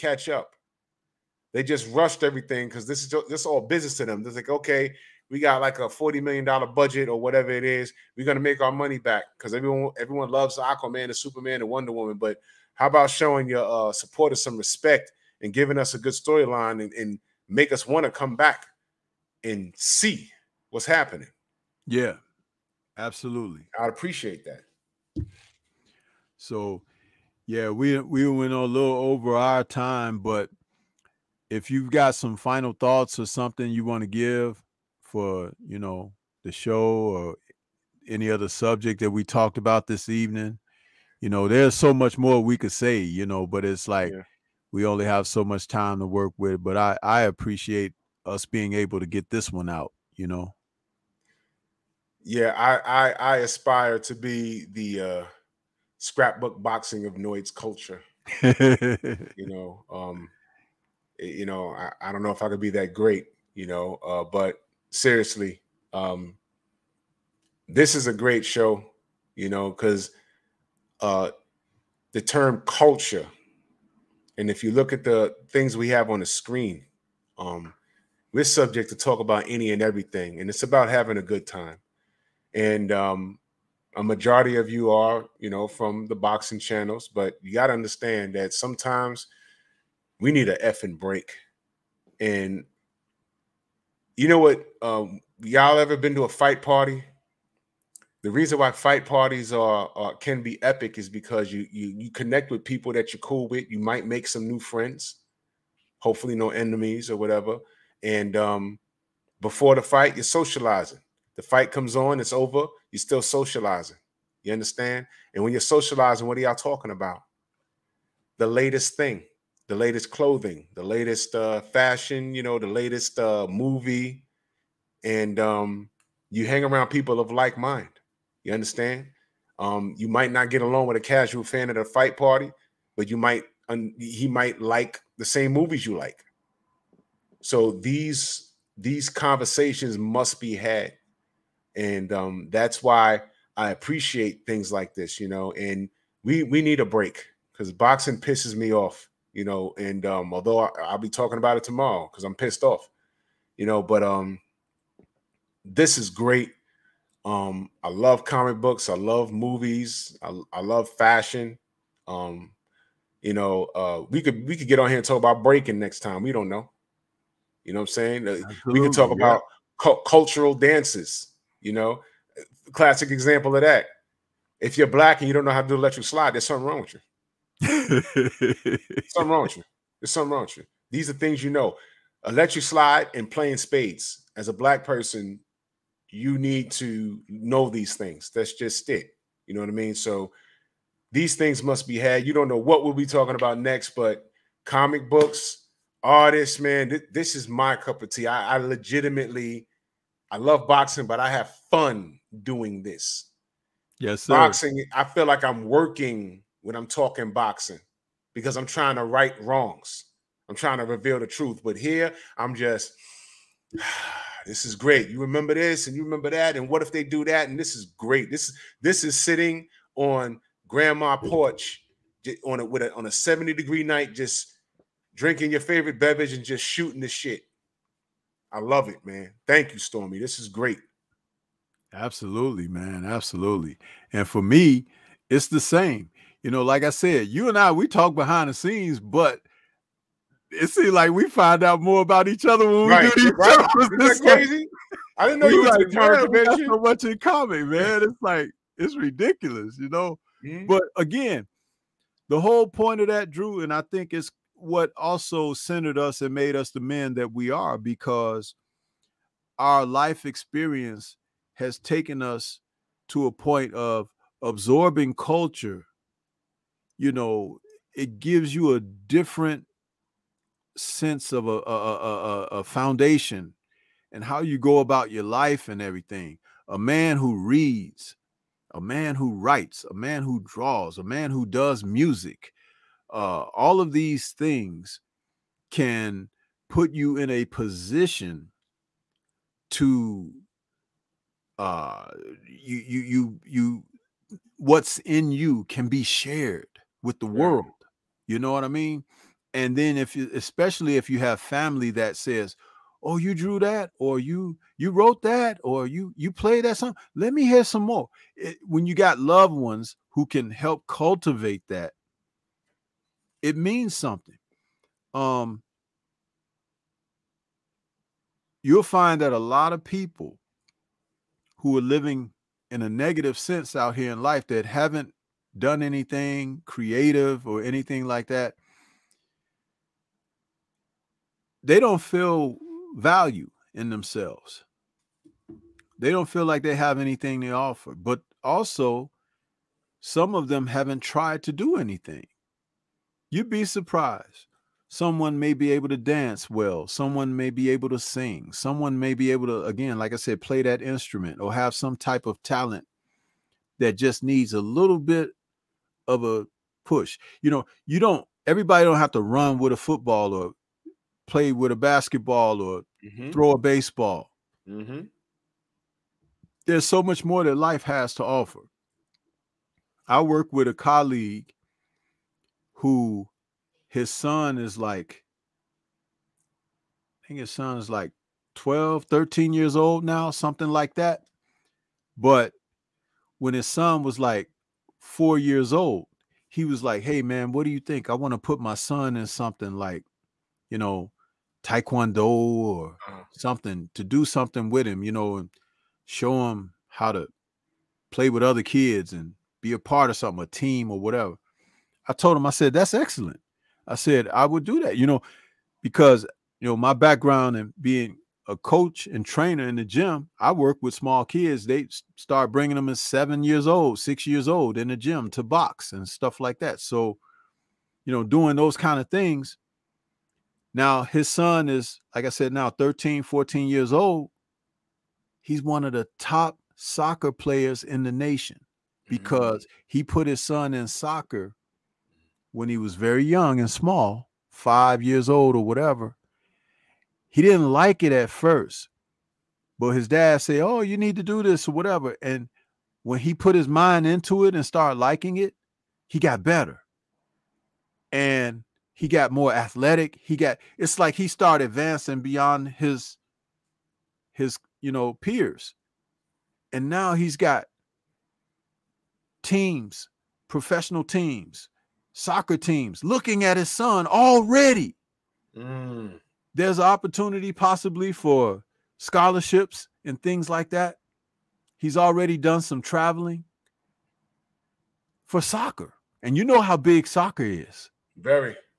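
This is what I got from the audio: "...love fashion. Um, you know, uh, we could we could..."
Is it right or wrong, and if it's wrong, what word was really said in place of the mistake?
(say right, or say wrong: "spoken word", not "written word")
right.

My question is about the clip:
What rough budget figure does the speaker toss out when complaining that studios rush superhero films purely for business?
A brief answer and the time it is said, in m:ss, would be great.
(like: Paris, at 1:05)
$40 million, at 0:05.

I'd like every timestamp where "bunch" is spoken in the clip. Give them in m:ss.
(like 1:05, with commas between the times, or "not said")
not said.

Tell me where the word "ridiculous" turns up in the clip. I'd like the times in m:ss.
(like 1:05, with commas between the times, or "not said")
4:08.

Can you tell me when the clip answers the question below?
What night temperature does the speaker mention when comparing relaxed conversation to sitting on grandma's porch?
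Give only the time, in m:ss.
3:43.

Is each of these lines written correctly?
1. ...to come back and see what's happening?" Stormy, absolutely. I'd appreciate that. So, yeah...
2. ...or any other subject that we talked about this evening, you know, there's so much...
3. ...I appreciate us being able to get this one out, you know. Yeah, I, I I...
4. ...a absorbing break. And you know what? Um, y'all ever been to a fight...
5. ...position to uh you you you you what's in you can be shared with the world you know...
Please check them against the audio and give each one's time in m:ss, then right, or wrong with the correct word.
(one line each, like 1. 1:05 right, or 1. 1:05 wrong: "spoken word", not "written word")
1. 0:18 wrong: "Yeah", not "Stormy"
2. 0:36 right
3. 0:47 right
4. 1:30 wrong: "effing", not "absorbing"
5. 4:47 right.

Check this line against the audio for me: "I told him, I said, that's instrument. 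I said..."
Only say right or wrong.
wrong.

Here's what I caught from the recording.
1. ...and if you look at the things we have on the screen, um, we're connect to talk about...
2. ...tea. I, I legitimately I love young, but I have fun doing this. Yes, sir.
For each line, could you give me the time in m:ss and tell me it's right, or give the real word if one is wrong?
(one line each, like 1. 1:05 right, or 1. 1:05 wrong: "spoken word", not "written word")
1. 1:14 wrong: "subject", not "connect"
2. 3:18 wrong: "boxing", not "young".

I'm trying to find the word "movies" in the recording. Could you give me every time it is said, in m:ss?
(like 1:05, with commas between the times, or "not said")
2:03, 2:15, 2:39.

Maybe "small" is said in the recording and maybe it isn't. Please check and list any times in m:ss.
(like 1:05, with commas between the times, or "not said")
6:50, 7:13.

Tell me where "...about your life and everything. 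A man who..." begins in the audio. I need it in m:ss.
4:34.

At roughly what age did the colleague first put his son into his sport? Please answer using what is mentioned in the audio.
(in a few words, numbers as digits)
5.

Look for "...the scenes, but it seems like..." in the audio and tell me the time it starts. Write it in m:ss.
3:58.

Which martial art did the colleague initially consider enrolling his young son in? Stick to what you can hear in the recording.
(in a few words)
Taekwondo.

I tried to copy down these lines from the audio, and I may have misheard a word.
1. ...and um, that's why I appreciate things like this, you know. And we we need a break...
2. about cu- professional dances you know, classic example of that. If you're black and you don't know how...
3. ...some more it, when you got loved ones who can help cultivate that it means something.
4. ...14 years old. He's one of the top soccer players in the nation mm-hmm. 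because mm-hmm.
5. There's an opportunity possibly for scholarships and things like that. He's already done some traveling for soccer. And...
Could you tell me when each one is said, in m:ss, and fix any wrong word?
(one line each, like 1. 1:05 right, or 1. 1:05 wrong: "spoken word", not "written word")
1. 2:21 right
2. 2:49 wrong: "cultural", not "professional"
3. 5:07 right
4. 7:03 right
5. 7:46 right.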